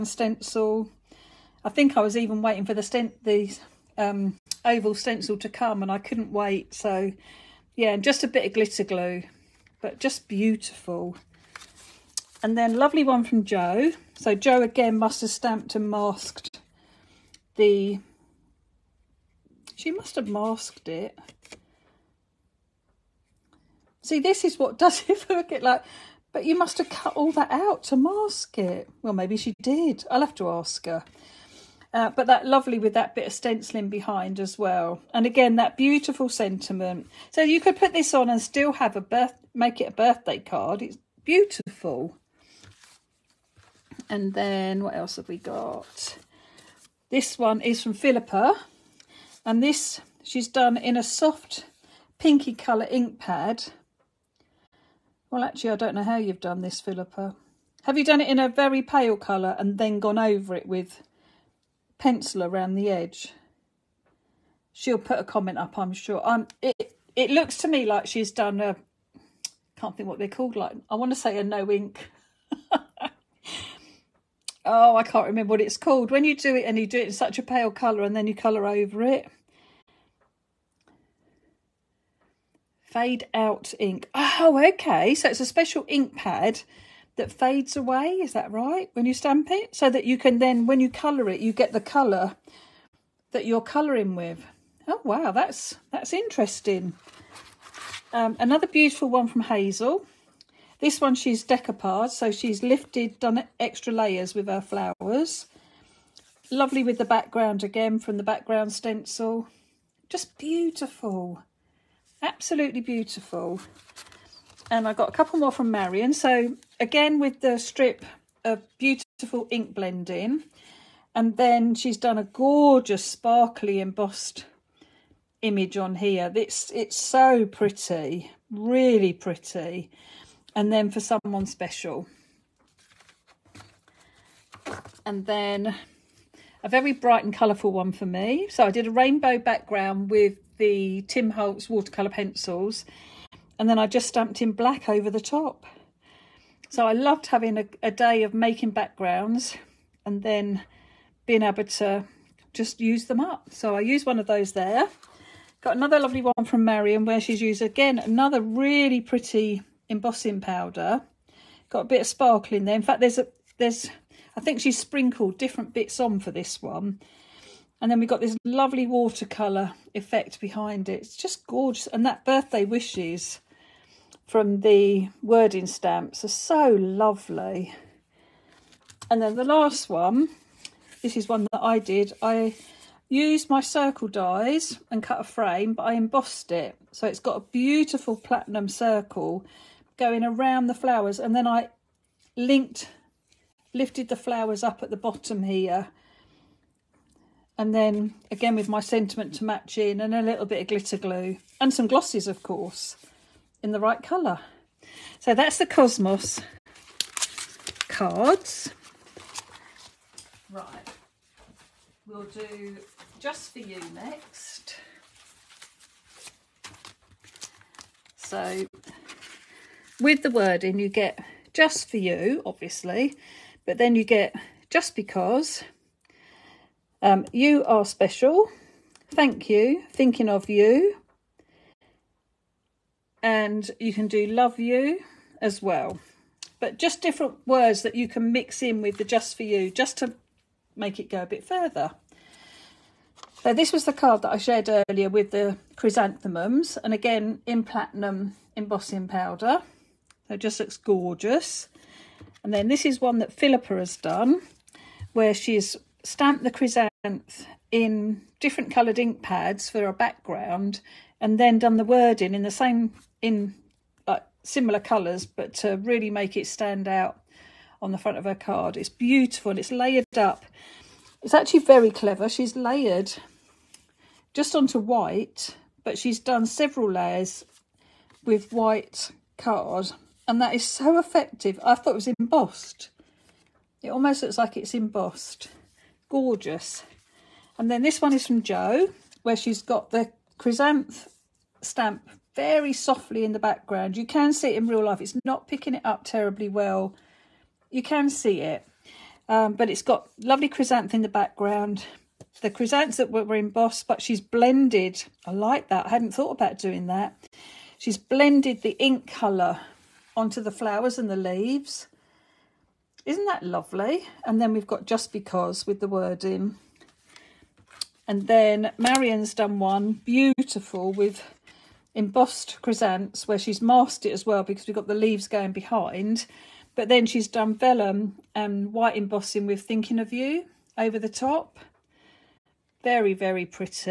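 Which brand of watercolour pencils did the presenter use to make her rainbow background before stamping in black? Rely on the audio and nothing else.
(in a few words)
Tim Holtz.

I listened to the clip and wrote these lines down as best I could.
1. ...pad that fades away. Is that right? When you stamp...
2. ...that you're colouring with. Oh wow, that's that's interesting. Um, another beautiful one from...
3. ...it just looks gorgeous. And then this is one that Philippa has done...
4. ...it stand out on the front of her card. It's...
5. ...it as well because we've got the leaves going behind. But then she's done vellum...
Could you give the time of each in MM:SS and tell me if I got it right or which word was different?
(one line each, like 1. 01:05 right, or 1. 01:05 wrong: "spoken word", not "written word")
1. 01:26 right
2. 01:33 right
3. 04:10 right
4. 04:26 right
5. 05:24 right.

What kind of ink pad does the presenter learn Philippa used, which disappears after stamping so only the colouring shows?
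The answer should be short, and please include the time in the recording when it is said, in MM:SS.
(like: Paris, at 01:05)
Fade out ink, at 01:22.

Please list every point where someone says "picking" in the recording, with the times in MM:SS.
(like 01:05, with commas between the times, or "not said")
04:55.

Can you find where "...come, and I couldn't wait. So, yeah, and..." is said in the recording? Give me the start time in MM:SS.
00:05.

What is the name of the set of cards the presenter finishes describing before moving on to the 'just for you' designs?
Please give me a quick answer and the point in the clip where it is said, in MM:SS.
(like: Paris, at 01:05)
Cosmos cards, at 03:25.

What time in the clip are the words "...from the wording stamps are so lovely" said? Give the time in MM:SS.
02:54.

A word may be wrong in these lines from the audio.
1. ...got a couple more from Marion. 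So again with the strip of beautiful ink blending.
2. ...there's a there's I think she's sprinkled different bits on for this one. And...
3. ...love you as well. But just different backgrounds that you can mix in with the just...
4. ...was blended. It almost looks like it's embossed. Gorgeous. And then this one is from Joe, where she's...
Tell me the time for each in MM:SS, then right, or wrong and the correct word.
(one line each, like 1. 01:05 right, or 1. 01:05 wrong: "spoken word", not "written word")
1. 01:54 right
2. 02:43 right
3. 03:54 wrong: "words", not "backgrounds"
4. 04:41 wrong: "embossed", not "blended".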